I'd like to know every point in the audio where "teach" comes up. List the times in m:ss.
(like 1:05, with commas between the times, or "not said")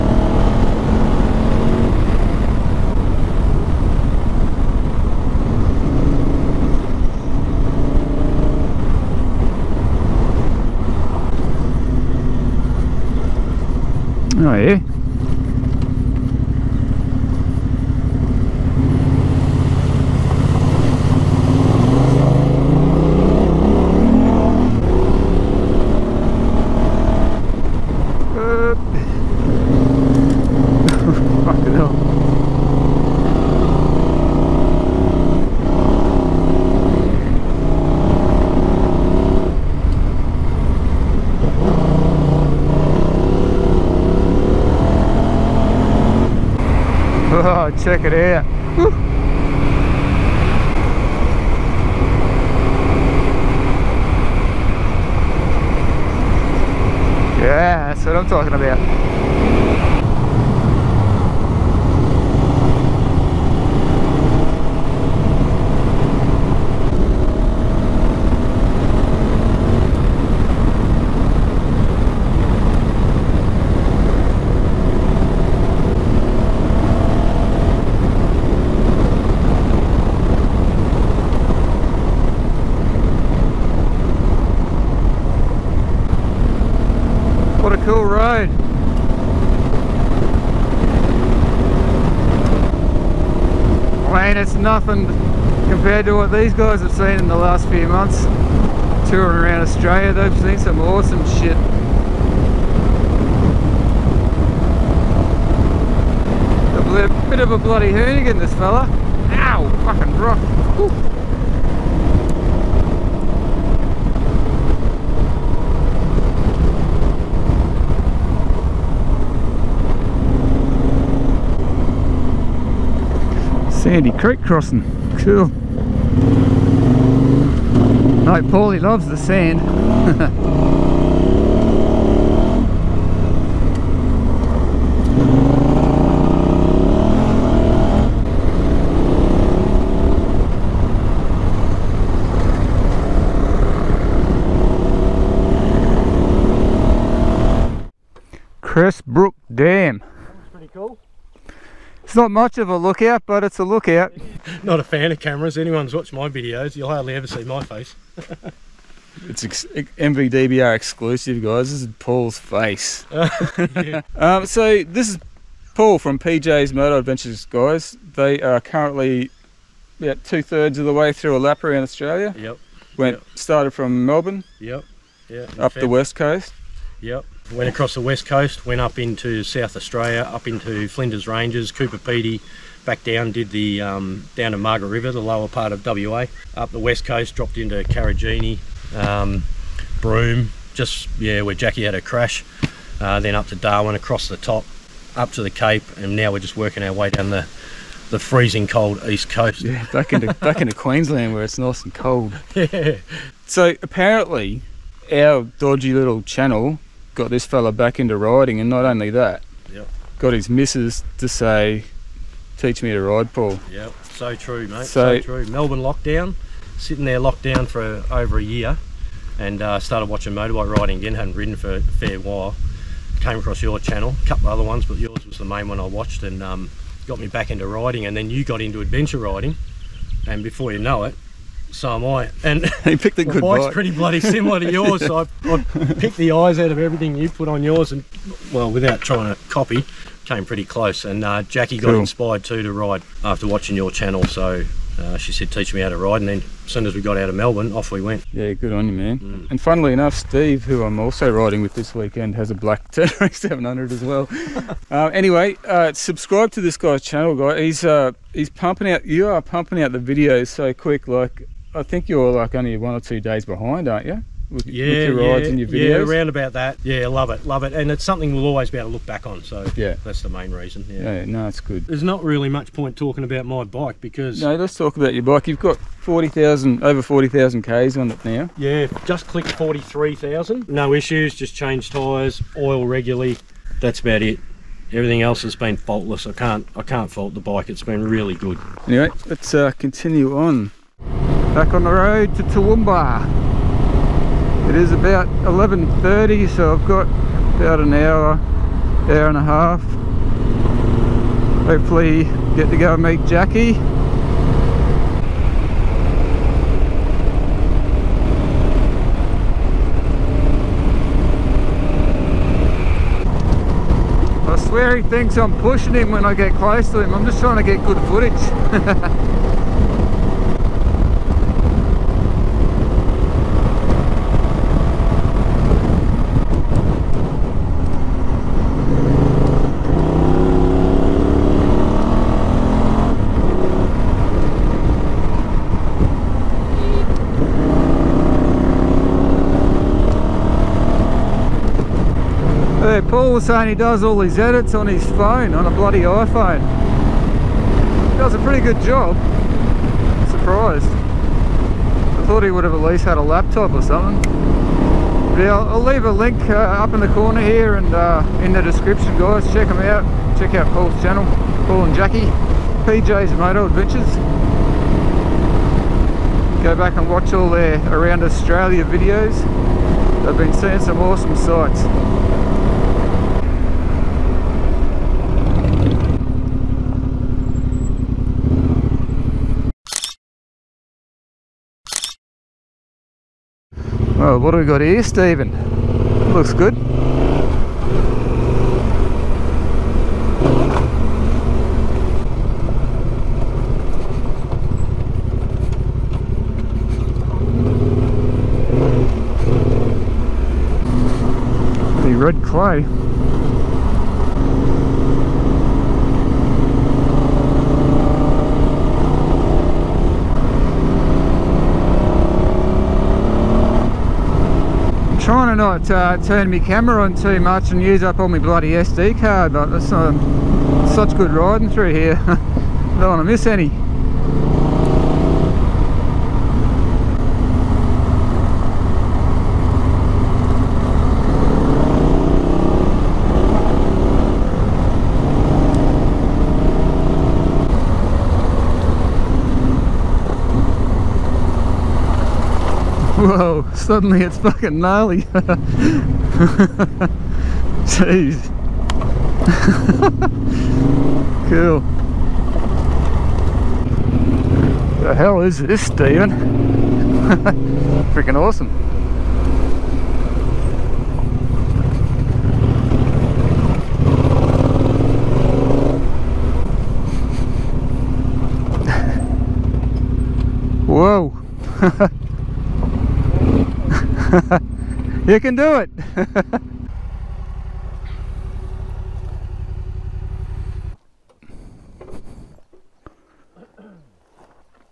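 3:32, 4:05.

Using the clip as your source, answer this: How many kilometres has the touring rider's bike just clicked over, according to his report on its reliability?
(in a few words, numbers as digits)
43,000.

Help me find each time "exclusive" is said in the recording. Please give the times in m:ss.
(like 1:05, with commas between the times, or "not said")
2:40.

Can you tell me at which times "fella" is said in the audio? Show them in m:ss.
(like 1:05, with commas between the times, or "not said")
1:48, 3:27.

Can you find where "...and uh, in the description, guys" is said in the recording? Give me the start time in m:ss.
5:57.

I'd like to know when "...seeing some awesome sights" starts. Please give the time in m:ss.
6:10.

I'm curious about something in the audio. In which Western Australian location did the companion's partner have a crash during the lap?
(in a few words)
Broome.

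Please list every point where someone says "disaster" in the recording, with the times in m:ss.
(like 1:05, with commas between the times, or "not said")
not said.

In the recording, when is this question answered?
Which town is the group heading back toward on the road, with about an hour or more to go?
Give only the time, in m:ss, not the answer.
4:52.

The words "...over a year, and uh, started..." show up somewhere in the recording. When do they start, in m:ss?
3:38.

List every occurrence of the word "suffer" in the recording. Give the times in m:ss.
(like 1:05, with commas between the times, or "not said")
not said.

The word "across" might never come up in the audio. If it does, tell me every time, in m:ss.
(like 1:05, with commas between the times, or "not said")
2:57, 3:13, 3:43.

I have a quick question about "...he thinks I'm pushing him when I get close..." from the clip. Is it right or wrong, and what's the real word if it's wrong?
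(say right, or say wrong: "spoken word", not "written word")
right.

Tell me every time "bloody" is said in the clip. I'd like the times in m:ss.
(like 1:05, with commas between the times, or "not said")
1:47, 3:53, 5:45, 6:58.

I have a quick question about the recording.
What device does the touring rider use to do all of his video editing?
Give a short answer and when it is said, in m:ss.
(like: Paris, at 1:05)
iPhone, at 5:46.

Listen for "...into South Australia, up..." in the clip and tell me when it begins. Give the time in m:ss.
2:58.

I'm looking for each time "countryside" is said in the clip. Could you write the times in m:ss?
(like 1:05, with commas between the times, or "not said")
not said.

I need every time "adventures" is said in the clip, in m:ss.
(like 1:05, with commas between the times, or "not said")
2:46, 3:48, 6:03.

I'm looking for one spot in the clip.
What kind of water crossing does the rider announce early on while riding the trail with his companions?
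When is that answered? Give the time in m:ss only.
2:03.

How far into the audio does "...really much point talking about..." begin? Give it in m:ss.
4:32.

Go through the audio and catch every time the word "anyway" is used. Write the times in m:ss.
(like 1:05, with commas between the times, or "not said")
4:15, 4:48.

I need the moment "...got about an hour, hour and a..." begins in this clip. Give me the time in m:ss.
4:56.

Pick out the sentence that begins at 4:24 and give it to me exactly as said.
With, yeah, with your rides yeah, and your videos.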